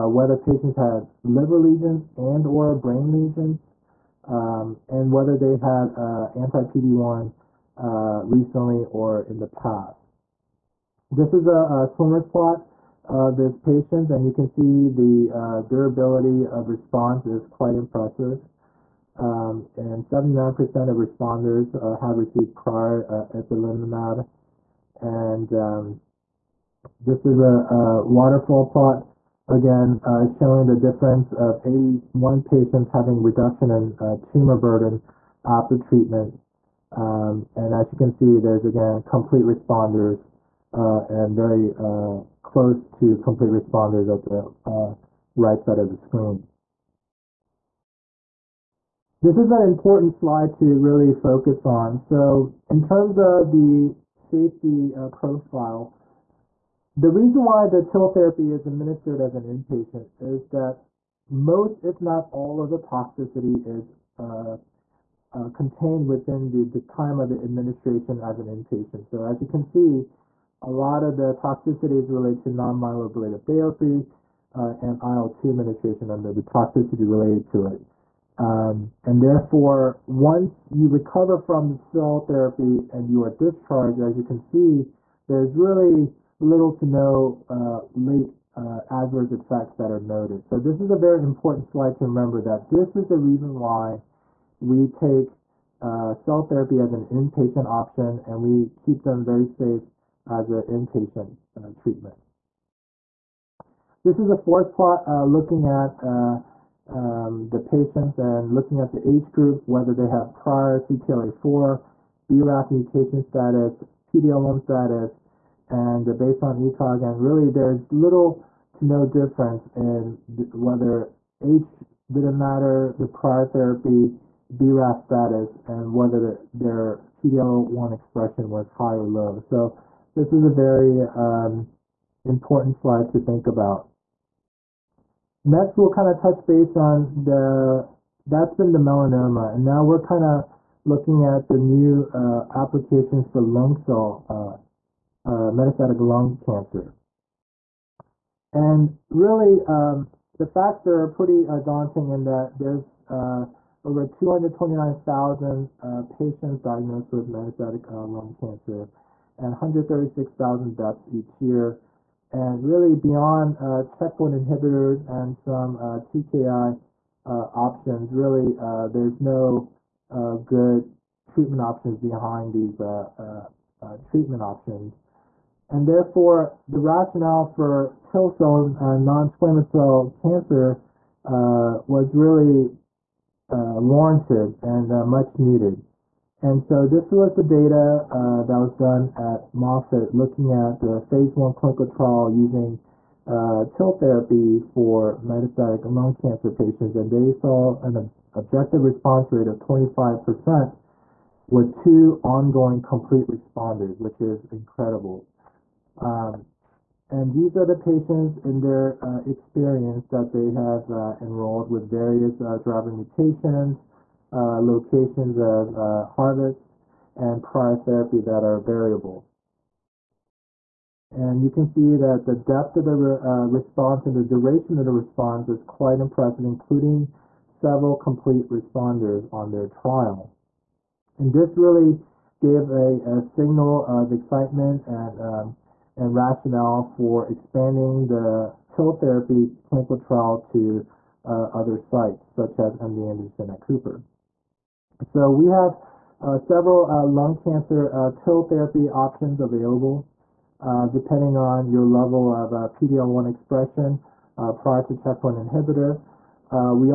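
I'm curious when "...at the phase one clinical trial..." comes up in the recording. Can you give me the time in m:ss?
3:10.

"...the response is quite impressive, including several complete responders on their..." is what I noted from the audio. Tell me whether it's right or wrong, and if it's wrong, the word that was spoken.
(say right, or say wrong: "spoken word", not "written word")
right.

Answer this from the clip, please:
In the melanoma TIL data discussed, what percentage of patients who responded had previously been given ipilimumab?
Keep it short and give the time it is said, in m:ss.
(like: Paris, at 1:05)
79%, at 0:20.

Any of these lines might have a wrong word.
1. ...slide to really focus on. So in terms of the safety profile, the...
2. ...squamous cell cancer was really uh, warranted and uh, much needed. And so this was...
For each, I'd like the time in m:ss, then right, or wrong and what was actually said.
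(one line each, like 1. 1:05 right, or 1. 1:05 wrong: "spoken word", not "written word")
1. 0:50 right
2. 2:59 right.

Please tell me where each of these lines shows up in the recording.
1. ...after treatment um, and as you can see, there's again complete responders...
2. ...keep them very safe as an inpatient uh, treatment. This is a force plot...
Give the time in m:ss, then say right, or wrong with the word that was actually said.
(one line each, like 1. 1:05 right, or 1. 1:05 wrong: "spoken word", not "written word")
1. 0:35 right
2. 1:38 right.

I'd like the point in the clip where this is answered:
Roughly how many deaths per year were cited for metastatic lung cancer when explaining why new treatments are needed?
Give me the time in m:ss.
2:39.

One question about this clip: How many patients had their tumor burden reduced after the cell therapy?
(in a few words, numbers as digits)
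81.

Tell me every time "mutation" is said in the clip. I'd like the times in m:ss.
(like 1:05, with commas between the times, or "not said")
1:52, 3:32.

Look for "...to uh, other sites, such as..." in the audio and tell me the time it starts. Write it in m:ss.
4:00.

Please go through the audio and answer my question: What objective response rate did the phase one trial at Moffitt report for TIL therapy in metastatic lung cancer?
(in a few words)
25%.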